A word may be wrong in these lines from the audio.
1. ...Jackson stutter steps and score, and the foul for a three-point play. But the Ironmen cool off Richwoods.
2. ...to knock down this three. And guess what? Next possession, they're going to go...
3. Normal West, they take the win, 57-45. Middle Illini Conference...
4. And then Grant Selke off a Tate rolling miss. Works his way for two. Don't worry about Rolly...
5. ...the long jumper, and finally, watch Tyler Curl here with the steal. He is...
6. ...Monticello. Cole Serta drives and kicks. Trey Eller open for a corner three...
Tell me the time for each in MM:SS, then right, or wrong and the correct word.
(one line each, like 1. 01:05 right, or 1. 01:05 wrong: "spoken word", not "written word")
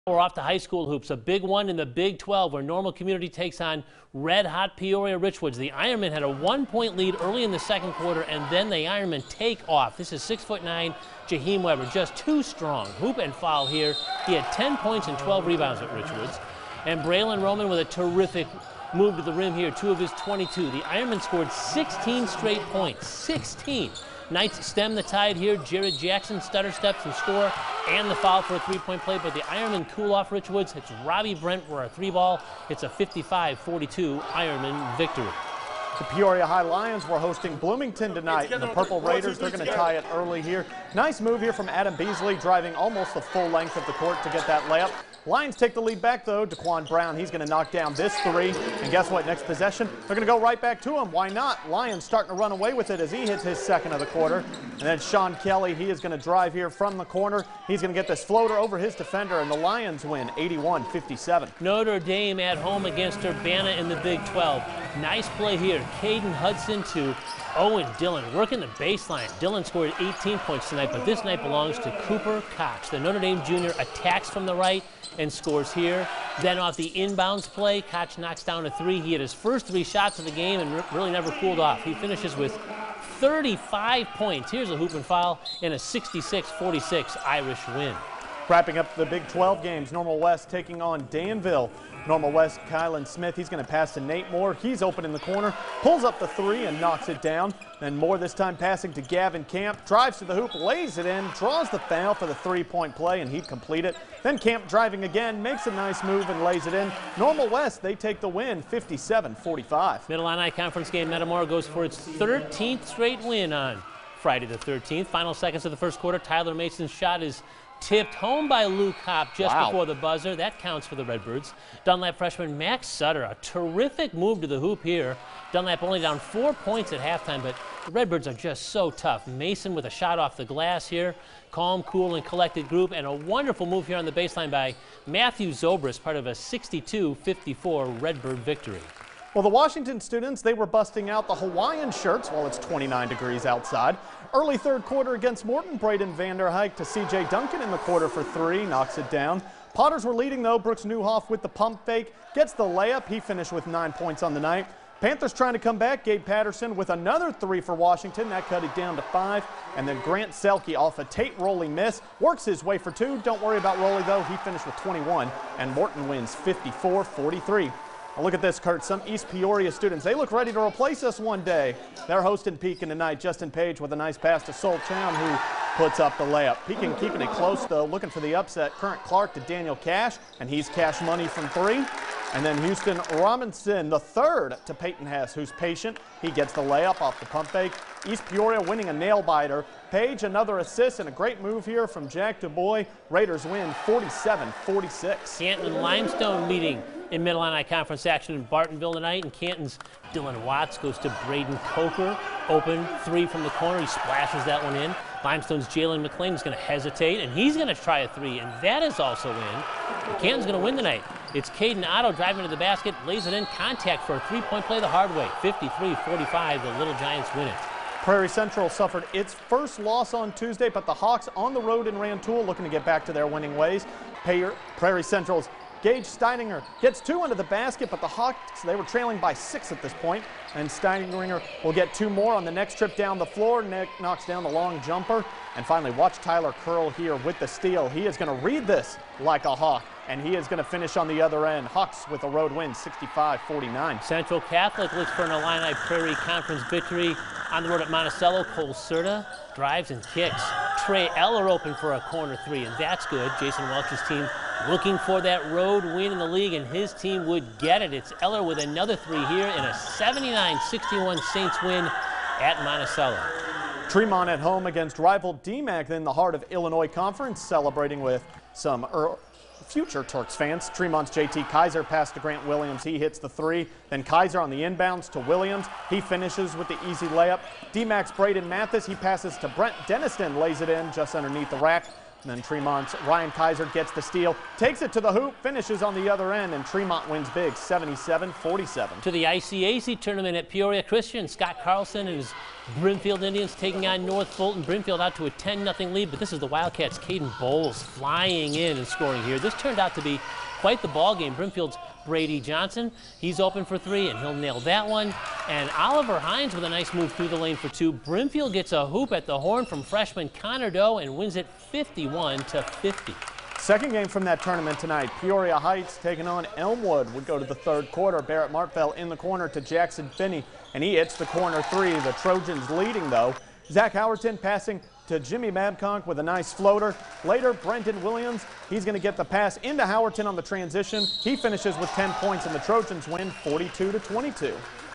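1. 00:25 right
2. 00:47 right
3. 01:47 right
4. 02:39 right
5. 03:54 right
6. 04:07 right.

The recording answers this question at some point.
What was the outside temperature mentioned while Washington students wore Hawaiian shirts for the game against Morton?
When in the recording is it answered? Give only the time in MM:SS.
02:22.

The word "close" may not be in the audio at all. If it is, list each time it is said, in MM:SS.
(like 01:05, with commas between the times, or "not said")
02:57.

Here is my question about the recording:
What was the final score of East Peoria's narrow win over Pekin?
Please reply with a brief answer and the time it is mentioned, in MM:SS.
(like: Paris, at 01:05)
47-46, at 03:13.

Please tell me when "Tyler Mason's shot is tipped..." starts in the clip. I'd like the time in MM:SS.
01:56.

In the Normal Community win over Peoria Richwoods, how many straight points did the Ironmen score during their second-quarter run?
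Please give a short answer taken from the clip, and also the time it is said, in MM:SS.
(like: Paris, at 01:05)
16, at 00:21.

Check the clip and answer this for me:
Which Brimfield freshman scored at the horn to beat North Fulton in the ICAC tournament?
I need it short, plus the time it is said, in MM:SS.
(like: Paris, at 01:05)
Connor Doe, at 05:10.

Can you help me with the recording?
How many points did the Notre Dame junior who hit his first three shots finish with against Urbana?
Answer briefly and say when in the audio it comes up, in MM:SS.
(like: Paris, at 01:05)
35, at 01:23.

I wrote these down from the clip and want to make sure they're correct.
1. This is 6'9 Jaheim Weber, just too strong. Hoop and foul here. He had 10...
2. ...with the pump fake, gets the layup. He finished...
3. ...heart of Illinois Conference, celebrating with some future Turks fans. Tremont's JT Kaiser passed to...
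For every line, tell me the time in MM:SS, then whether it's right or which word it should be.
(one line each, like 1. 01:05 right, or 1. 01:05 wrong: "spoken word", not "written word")
1. 00:09 right
2. 02:31 right
3. 04:26 right.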